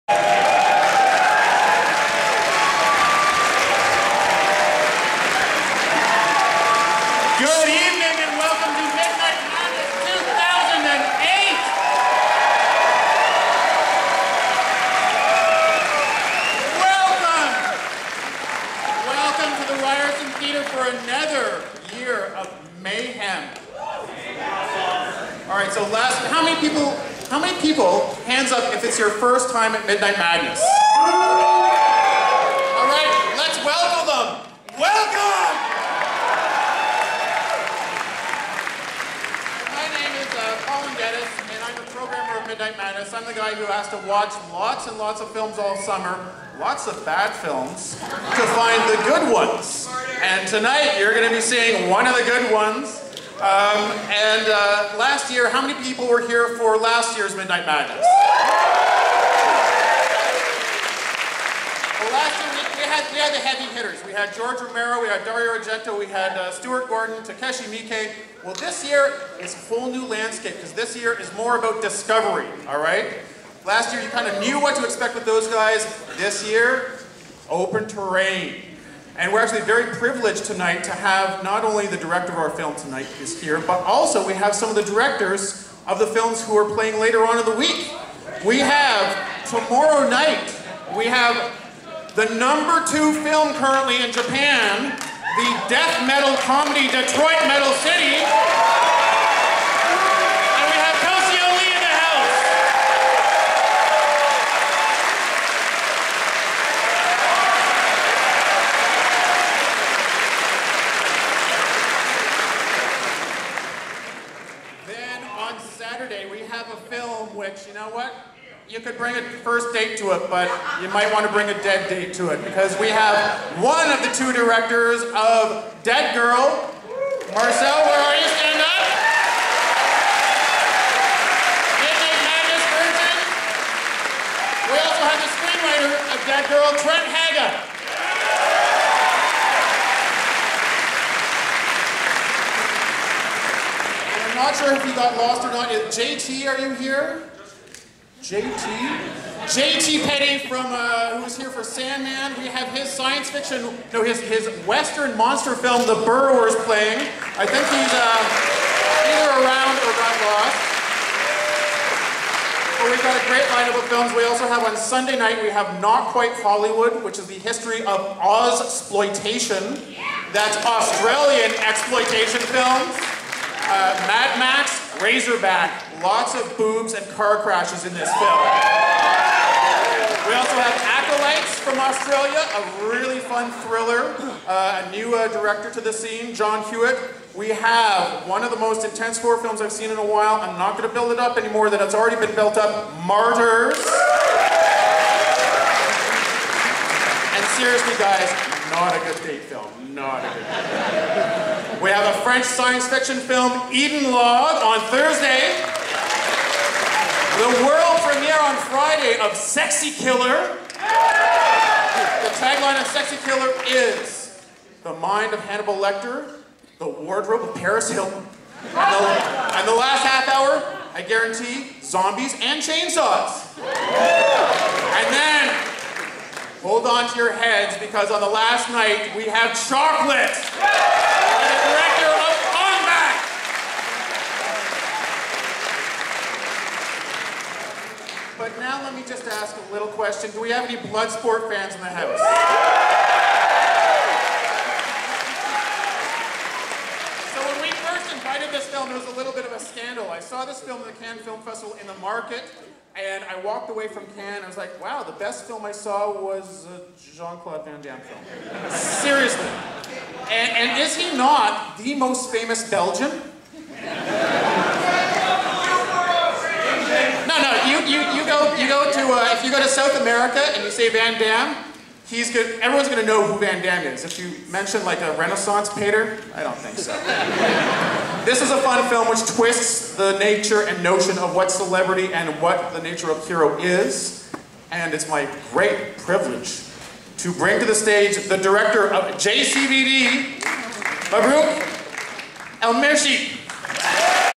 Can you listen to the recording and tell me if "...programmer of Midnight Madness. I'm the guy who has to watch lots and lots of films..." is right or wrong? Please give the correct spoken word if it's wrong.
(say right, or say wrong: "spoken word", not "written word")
right.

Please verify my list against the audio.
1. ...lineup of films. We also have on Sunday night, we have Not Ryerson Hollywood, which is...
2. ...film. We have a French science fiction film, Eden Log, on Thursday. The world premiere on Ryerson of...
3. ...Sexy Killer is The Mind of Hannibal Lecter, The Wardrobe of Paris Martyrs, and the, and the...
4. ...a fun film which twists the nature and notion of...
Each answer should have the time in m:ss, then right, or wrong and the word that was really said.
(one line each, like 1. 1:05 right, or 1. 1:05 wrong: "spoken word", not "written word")
1. 2:43 wrong: "Quite", not "Ryerson"
2. 3:21 wrong: "Friday", not "Ryerson"
3. 3:32 wrong: "Hilton", not "Martyrs"
4. 4:38 right.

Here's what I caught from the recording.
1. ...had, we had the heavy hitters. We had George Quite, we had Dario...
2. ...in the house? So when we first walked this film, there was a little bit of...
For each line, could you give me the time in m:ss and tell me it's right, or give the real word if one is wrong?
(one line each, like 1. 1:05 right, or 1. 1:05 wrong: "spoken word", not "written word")
1. 1:02 wrong: "Romero", not "Quite"
2. 4:01 wrong: "invited", not "walked".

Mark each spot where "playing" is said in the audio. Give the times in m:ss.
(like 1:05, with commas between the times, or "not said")
1:26, 2:36.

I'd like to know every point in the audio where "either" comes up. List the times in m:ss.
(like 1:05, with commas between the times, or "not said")
2:39.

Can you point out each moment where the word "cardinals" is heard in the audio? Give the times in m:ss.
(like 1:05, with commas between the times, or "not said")
not said.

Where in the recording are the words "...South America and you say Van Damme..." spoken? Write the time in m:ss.
4:29.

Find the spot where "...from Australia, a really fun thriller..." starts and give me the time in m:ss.
3:01.